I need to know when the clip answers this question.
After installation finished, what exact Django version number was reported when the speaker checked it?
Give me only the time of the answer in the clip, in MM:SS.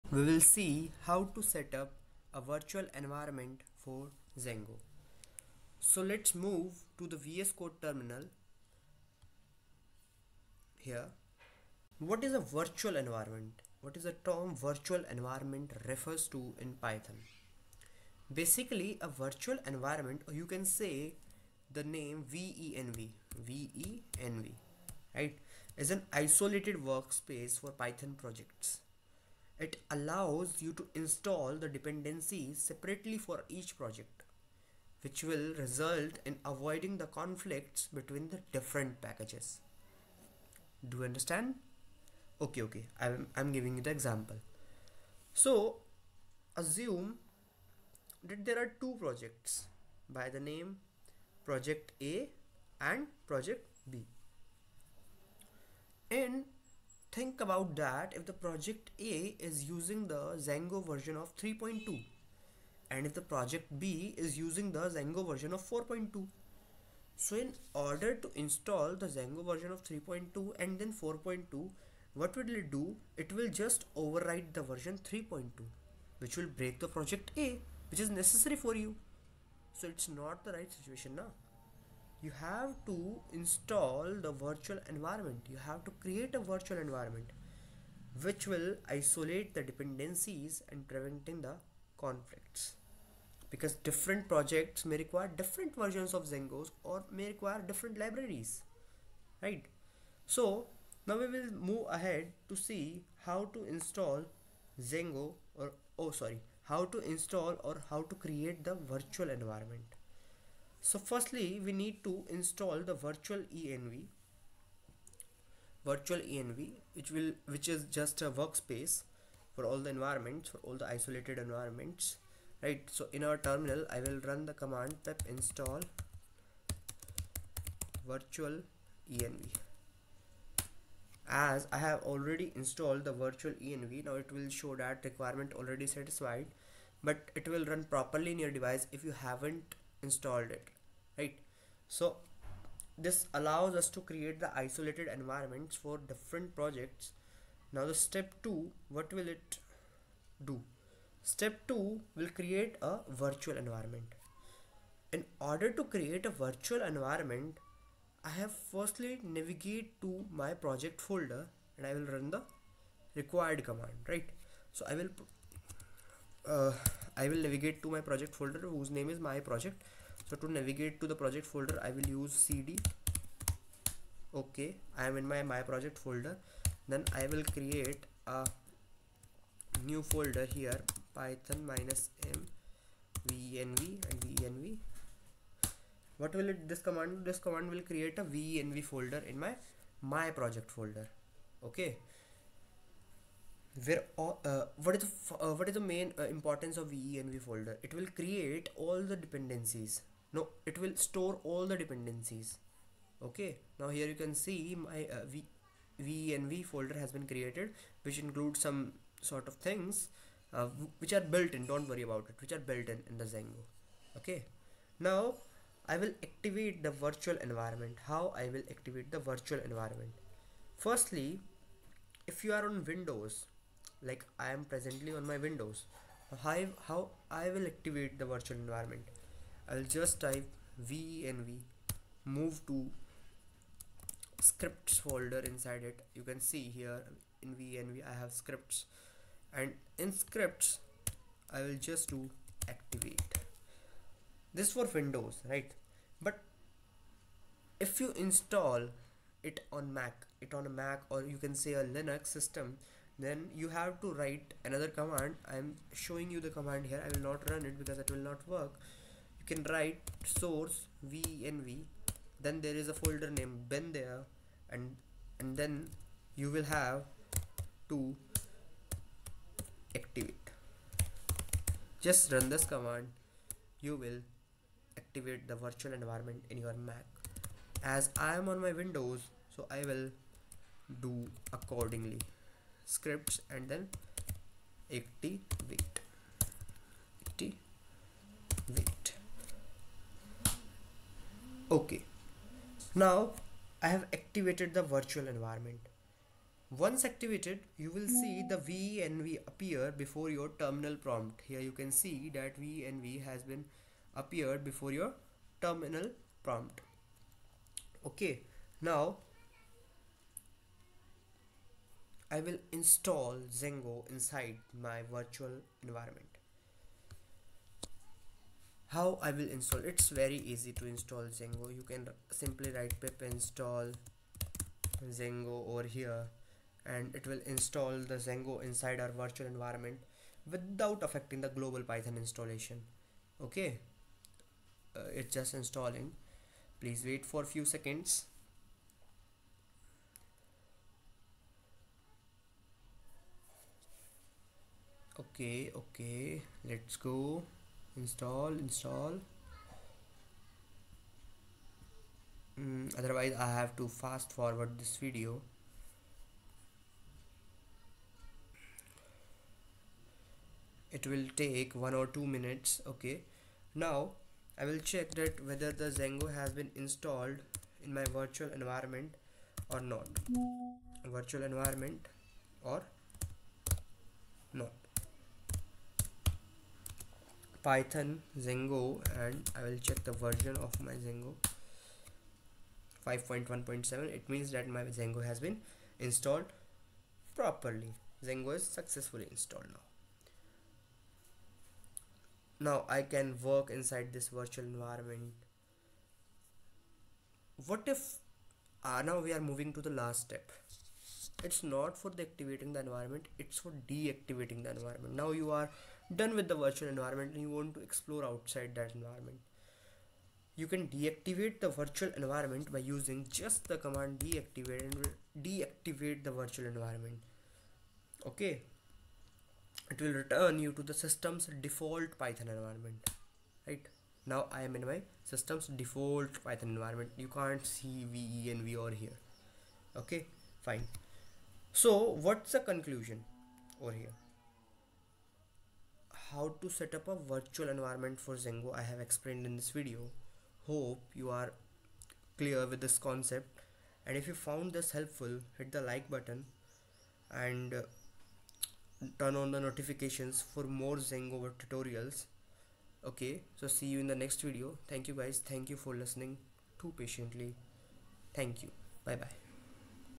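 06:23.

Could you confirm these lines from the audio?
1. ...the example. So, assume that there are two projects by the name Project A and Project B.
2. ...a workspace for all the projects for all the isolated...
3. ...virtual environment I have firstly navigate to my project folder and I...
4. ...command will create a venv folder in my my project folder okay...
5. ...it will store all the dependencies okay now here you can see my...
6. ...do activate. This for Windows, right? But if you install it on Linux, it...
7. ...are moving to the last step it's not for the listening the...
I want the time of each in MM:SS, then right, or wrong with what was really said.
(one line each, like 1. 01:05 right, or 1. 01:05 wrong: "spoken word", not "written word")
1. 00:43 right
2. 01:58 wrong: "environments", not "projects"
3. 02:36 right
4. 03:07 right
5. 03:20 right
6. 04:02 wrong: "Mac", not "Linux"
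7. 06:39 wrong: "activating", not "listening".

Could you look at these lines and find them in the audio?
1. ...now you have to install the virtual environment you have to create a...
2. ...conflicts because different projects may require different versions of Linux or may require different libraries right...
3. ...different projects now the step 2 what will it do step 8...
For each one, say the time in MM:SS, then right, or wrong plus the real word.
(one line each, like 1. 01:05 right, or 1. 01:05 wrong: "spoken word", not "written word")
1. 01:21 right
2. 01:32 wrong: "Djangos", not "Linux"
3. 02:26 wrong: "2", not "8".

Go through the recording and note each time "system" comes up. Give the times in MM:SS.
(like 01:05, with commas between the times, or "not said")
04:12, 07:00, 07:05.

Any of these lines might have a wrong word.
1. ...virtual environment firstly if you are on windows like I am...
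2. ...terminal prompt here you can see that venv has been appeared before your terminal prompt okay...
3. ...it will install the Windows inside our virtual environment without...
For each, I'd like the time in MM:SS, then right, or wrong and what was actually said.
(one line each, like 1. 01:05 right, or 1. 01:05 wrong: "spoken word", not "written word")
1. 03:39 right
2. 05:00 right
3. 05:27 wrong: "Django", not "Windows".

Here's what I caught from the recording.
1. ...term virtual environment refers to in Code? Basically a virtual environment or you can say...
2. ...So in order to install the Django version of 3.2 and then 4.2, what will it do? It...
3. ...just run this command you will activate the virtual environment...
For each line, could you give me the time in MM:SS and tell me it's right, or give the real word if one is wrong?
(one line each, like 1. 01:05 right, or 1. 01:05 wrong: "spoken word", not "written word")
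1. 00:14 wrong: "Python", not "Code"
2. 01:07 right
3. 04:32 right.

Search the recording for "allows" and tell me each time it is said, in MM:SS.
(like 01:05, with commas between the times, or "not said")
00:29, 02:23.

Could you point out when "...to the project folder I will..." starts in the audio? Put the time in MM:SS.
02:51.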